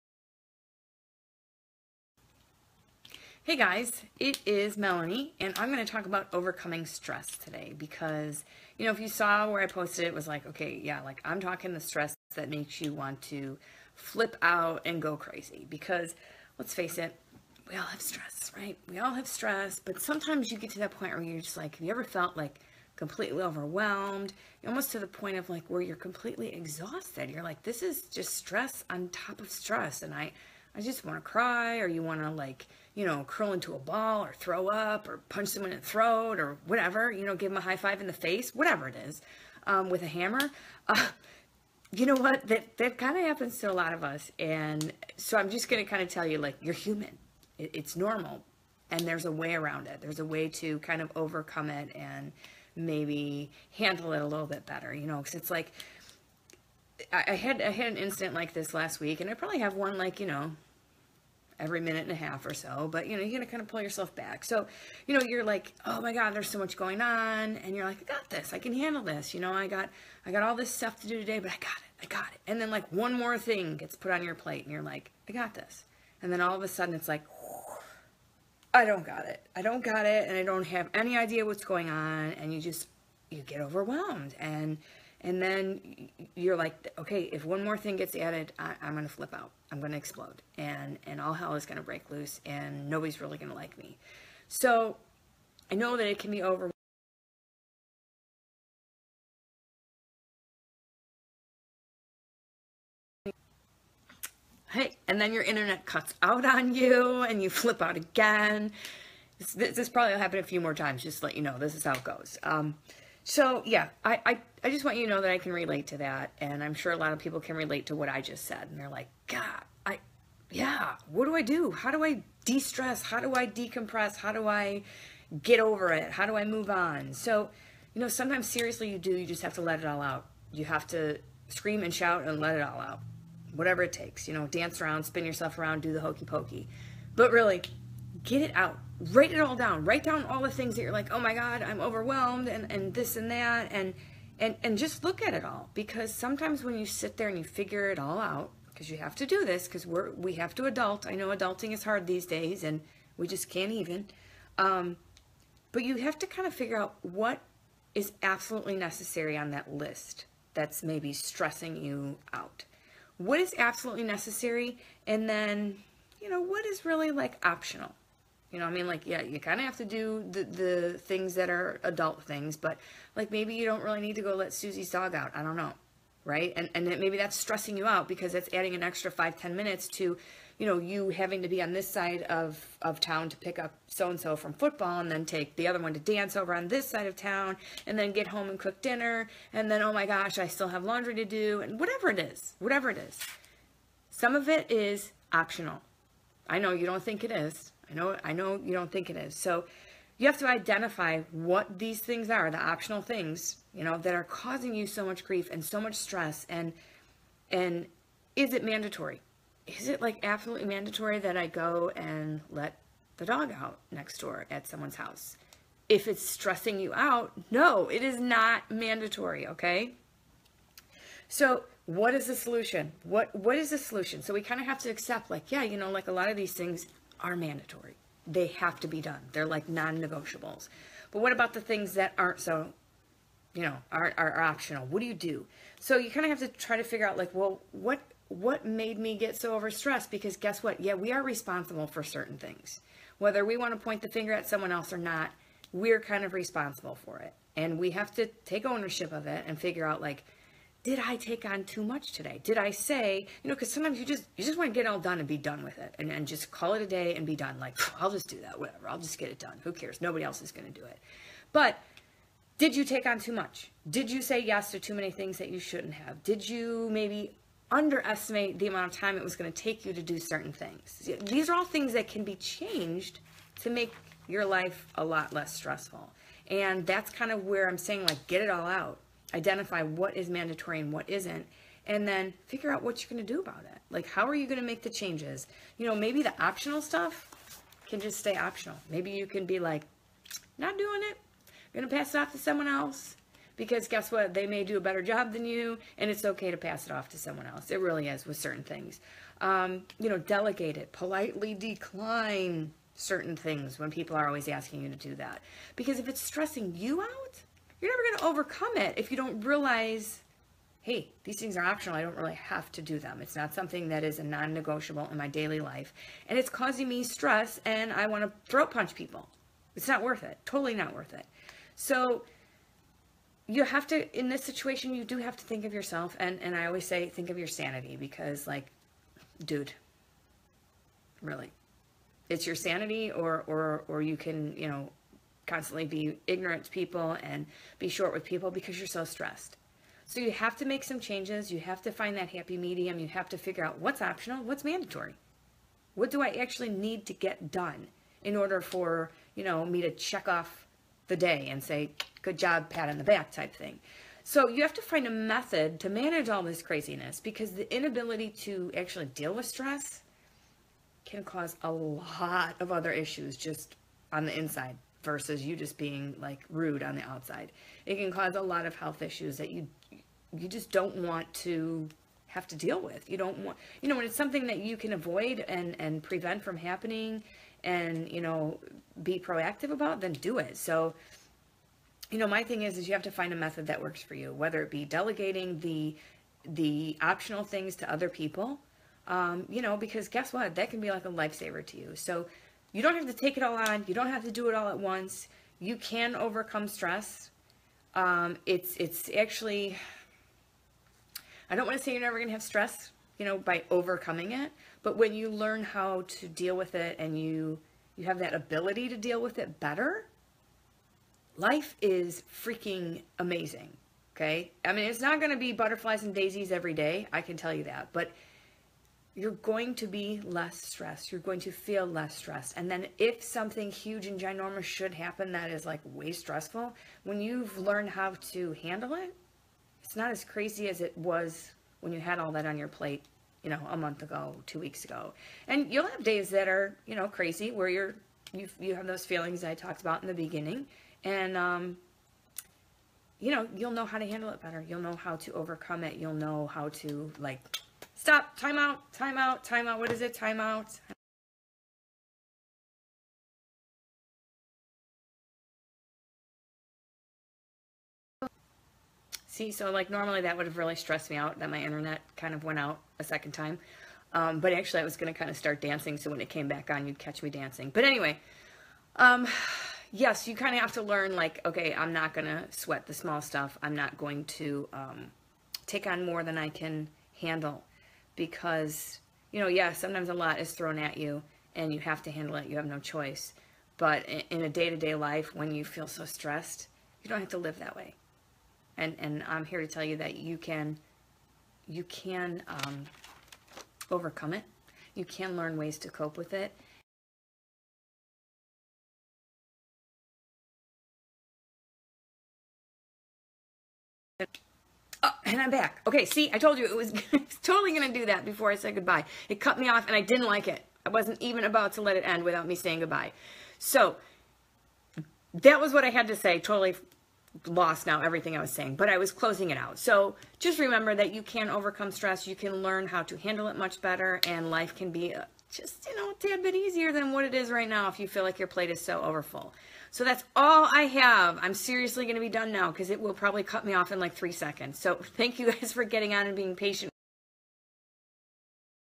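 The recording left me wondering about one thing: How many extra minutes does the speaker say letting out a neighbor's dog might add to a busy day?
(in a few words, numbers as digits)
5 to 10 minutes.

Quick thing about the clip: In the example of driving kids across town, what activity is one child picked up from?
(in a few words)
football.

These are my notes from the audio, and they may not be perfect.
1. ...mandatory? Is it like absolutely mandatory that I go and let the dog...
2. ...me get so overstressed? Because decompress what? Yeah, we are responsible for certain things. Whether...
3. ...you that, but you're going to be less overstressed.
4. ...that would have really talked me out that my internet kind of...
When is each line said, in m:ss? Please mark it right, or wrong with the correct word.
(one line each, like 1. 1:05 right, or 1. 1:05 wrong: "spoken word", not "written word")
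1. 3:28 right
2. 3:58 wrong: "guess", not "decompress"
3. 6:57 wrong: "stressed", not "overstressed"
4. 7:40 wrong: "stressed", not "talked".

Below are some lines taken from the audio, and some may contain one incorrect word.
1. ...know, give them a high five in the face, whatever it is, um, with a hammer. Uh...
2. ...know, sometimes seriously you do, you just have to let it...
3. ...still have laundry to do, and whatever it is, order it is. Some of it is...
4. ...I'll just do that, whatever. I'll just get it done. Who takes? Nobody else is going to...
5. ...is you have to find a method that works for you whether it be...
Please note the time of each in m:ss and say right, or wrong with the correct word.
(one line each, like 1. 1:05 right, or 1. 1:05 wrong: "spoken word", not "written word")
1. 0:37 right
2. 2:08 right
3. 3:10 wrong: "whatever", not "order"
4. 4:17 wrong: "cares", not "takes"
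5. 6:22 right.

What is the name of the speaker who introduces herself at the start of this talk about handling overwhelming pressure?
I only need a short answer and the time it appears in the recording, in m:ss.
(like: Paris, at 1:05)
Melanie, at 0:04.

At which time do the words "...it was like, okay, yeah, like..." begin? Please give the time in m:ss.
0:10.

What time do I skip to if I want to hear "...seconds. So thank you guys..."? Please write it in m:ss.
8:54.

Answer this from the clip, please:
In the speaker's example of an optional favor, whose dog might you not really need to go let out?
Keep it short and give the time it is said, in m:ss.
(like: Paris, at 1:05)
Susie's, at 2:54.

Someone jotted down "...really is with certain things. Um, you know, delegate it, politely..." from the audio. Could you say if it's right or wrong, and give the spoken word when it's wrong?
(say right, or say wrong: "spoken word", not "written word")
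right.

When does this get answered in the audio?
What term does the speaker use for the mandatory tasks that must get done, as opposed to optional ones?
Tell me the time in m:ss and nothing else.
3:49.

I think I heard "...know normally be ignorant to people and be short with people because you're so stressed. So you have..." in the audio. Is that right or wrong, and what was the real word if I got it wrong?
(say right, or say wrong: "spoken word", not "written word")
wrong: "constantly", not "normally".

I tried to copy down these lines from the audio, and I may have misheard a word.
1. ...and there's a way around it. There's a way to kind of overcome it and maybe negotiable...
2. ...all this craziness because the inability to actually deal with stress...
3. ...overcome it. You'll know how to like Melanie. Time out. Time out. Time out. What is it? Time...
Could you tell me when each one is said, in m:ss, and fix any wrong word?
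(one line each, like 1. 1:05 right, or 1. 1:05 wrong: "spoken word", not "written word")
1. 0:48 wrong: "handle", not "negotiable"
2. 5:56 right
3. 7:25 wrong: "Stop", not "Melanie".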